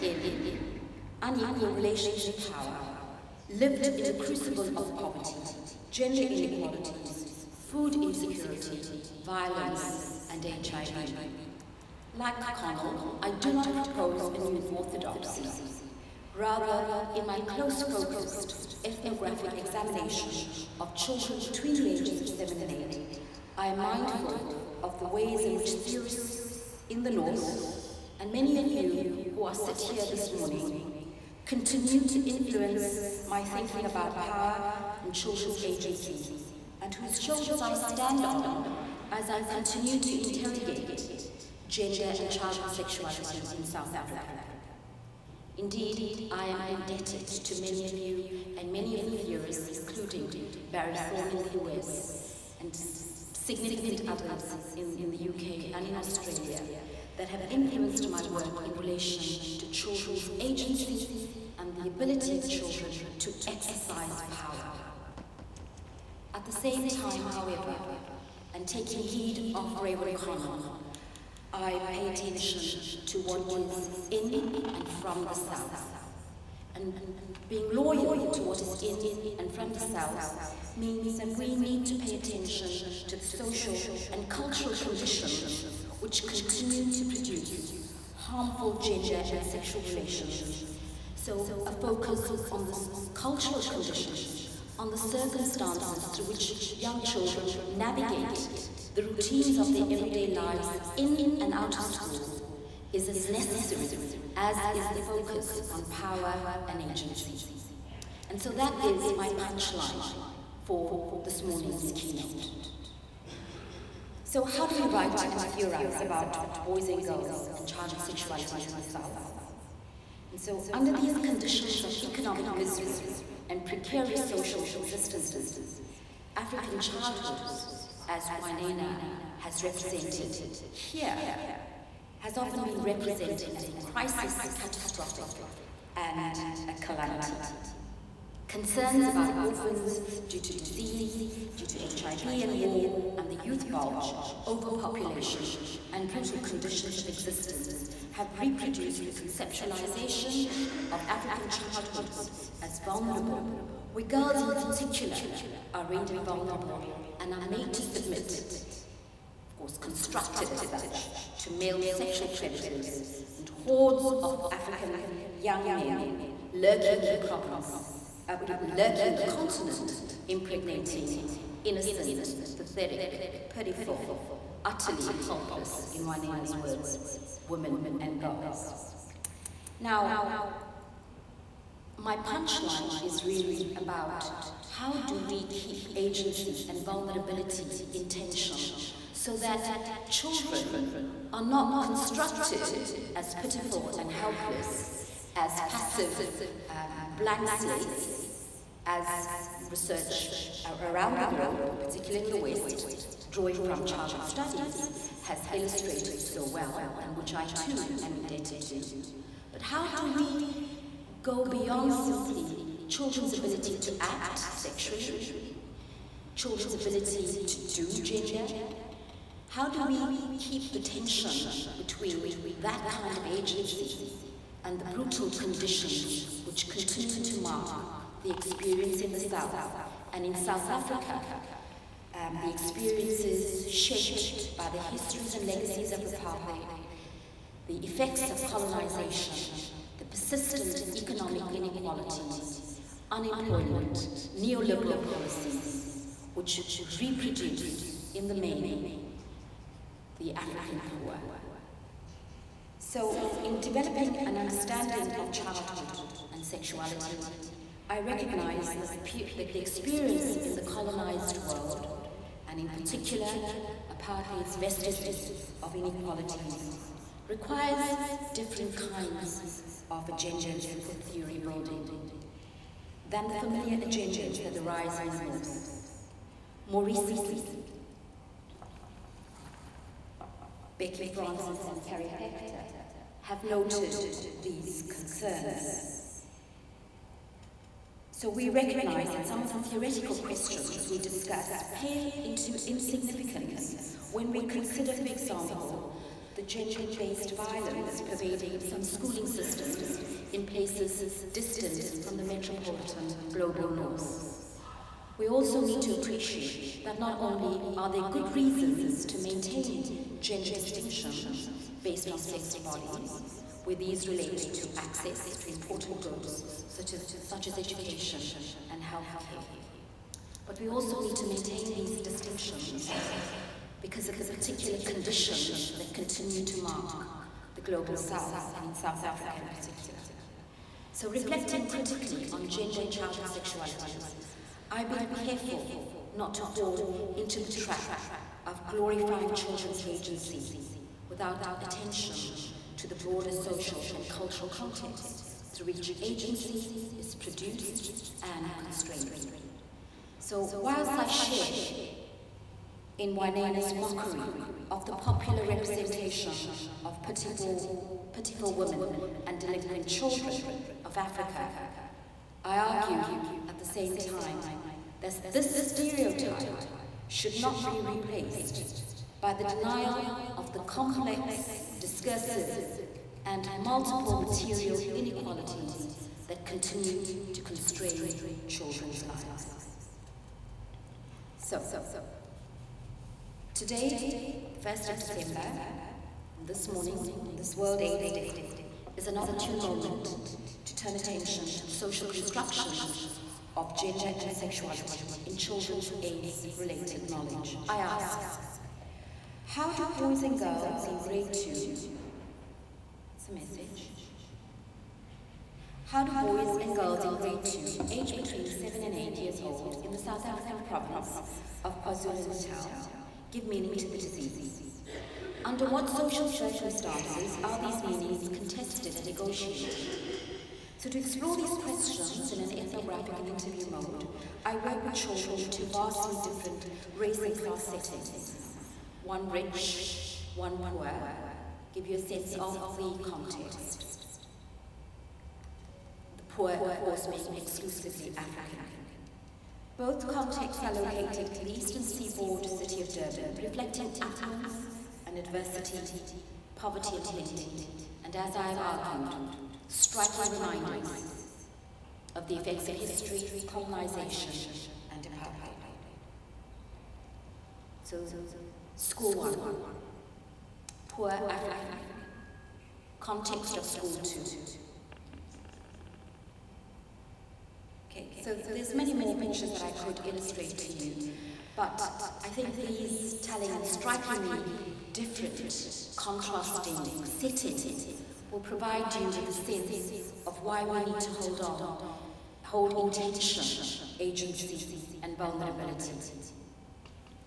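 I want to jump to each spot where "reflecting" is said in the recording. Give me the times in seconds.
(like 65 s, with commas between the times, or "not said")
331 s, 443 s.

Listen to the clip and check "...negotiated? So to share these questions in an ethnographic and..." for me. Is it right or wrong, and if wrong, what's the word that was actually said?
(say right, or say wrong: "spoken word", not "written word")
wrong: "explore", not "share".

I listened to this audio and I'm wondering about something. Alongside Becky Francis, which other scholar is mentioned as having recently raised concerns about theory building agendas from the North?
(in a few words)
Carrie Paechter.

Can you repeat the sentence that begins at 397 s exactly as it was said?
I ask, how do boys and girls in grade 2 message.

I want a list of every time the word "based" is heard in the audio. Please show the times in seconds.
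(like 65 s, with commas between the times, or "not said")
296 s, 311 s.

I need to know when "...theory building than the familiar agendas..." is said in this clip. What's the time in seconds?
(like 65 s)
270 s.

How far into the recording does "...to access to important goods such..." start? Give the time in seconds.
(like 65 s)
314 s.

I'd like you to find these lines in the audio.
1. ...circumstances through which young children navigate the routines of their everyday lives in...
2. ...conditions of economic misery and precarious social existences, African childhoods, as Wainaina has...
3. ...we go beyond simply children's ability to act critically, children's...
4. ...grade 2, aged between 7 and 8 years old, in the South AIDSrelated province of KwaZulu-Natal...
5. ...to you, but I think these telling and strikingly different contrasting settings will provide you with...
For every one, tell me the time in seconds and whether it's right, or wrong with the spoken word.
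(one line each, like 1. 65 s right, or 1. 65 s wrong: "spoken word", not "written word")
1. 94 s right
2. 121 s right
3. 210 s wrong: "sexually", not "critically"
4. 407 s wrong: "African", not "AIDSrelated"
5. 470 s right.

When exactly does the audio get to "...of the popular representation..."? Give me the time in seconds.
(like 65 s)
354 s.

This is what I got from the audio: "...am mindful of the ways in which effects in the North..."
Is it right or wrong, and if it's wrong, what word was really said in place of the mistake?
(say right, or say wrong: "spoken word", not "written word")
wrong: "theorists", not "effects".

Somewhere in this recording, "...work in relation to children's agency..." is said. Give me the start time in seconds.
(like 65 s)
58 s.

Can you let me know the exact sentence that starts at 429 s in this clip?
One rich, one poor, give you a sense of the context.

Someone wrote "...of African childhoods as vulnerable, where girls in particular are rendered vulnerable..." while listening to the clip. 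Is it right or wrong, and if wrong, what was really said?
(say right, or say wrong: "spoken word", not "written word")
right.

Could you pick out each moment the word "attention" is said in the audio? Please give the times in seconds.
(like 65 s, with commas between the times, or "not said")
72 s, 82 s, 341 s, 390 s.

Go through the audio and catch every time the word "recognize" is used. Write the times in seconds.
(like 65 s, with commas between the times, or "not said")
258 s, 288 s.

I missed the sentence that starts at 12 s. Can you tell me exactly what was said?
Like Connell, I do not propose a new orthodoxy.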